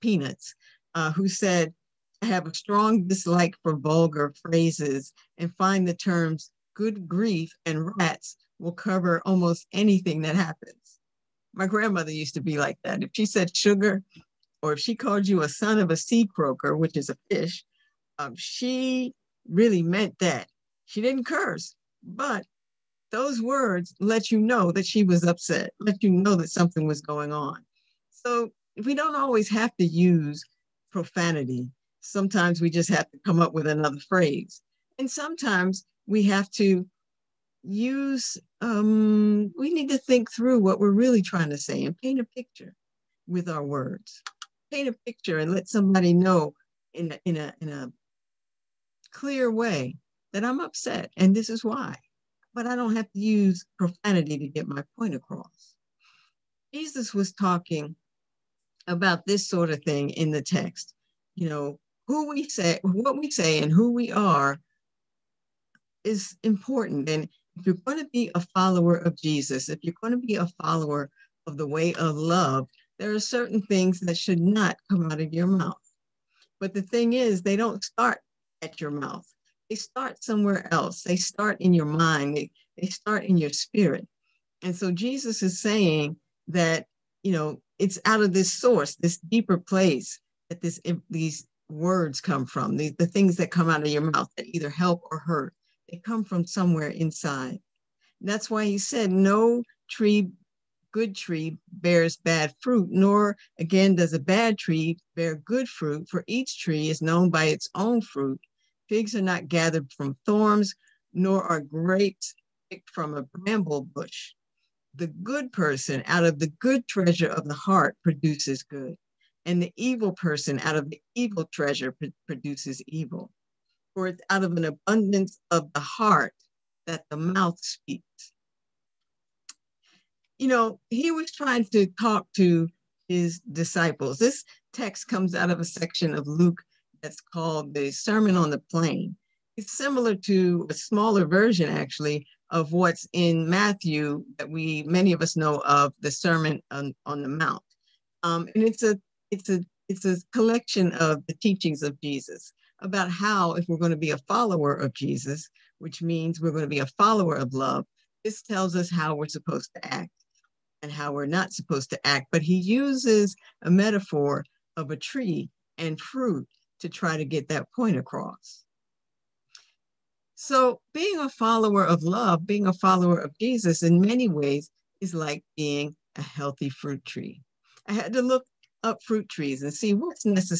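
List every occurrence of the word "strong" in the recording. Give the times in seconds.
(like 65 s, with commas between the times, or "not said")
2 s.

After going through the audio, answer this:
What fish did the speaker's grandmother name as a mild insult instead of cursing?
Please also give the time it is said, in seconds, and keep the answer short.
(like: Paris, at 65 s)
sea croaker, at 15 s.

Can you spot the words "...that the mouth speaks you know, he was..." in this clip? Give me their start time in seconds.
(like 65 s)
126 s.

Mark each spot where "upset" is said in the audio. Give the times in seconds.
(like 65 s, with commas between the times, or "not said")
25 s, 50 s.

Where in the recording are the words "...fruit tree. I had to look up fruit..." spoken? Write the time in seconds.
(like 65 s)
176 s.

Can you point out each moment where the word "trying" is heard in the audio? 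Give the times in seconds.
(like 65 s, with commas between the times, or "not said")
41 s, 131 s.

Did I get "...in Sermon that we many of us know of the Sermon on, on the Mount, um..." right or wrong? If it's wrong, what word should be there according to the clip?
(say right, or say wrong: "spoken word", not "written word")
wrong: "Matthew", not "Sermon".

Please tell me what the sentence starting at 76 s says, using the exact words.
But the thing is, they don't start at your mouth.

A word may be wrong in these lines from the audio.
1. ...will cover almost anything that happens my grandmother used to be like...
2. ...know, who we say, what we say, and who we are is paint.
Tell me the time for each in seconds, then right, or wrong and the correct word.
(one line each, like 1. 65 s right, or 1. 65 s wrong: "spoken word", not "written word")
1. 8 s right
2. 61 s wrong: "important", not "paint".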